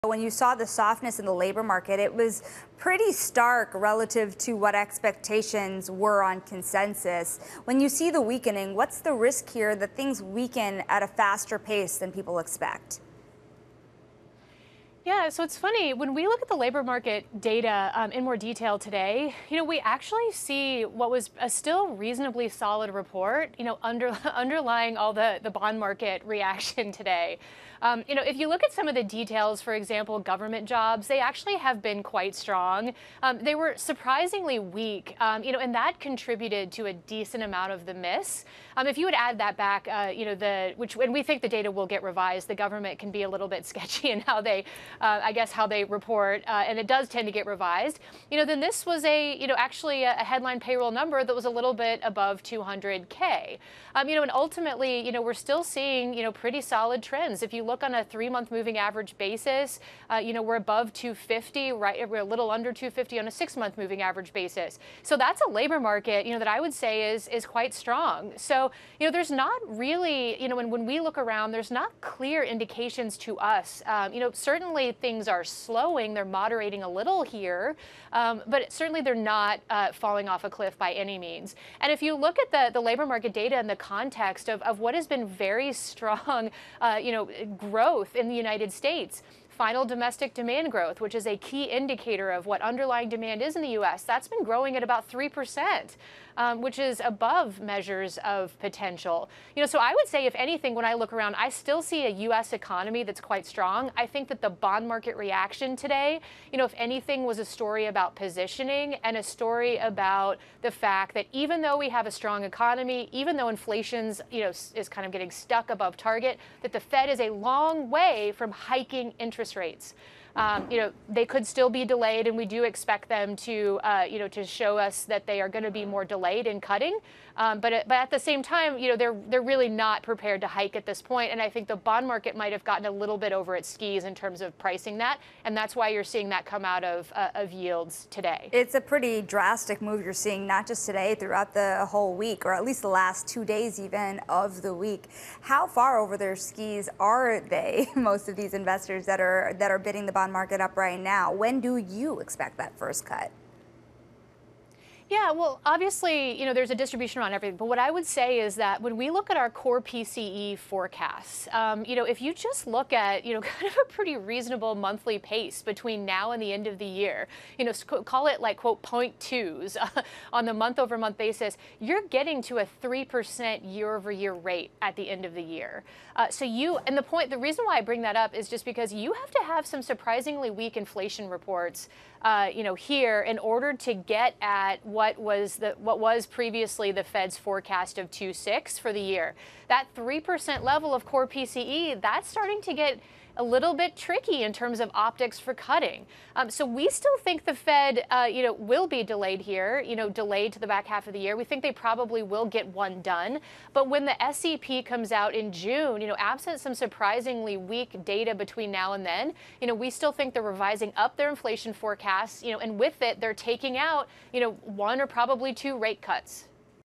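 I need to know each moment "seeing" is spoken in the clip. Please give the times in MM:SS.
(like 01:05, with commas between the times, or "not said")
00:55, 02:16, 02:20.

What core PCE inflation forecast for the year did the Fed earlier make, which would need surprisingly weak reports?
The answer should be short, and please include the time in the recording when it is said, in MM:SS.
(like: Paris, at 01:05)
2.6, at 03:08.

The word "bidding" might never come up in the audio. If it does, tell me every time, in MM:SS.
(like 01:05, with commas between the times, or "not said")
02:29.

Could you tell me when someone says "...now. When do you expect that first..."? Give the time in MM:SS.
02:30.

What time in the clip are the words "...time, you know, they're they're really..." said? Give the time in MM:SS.
02:08.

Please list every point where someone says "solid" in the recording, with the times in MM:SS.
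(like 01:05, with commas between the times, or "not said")
00:22, 00:56.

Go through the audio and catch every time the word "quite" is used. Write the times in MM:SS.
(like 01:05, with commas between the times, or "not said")
00:32, 01:07, 01:43.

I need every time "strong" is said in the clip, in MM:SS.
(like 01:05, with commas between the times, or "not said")
00:32, 01:07, 01:25, 01:43, 01:52.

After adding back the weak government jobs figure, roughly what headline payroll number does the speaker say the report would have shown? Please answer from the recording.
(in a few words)
a little above 200K.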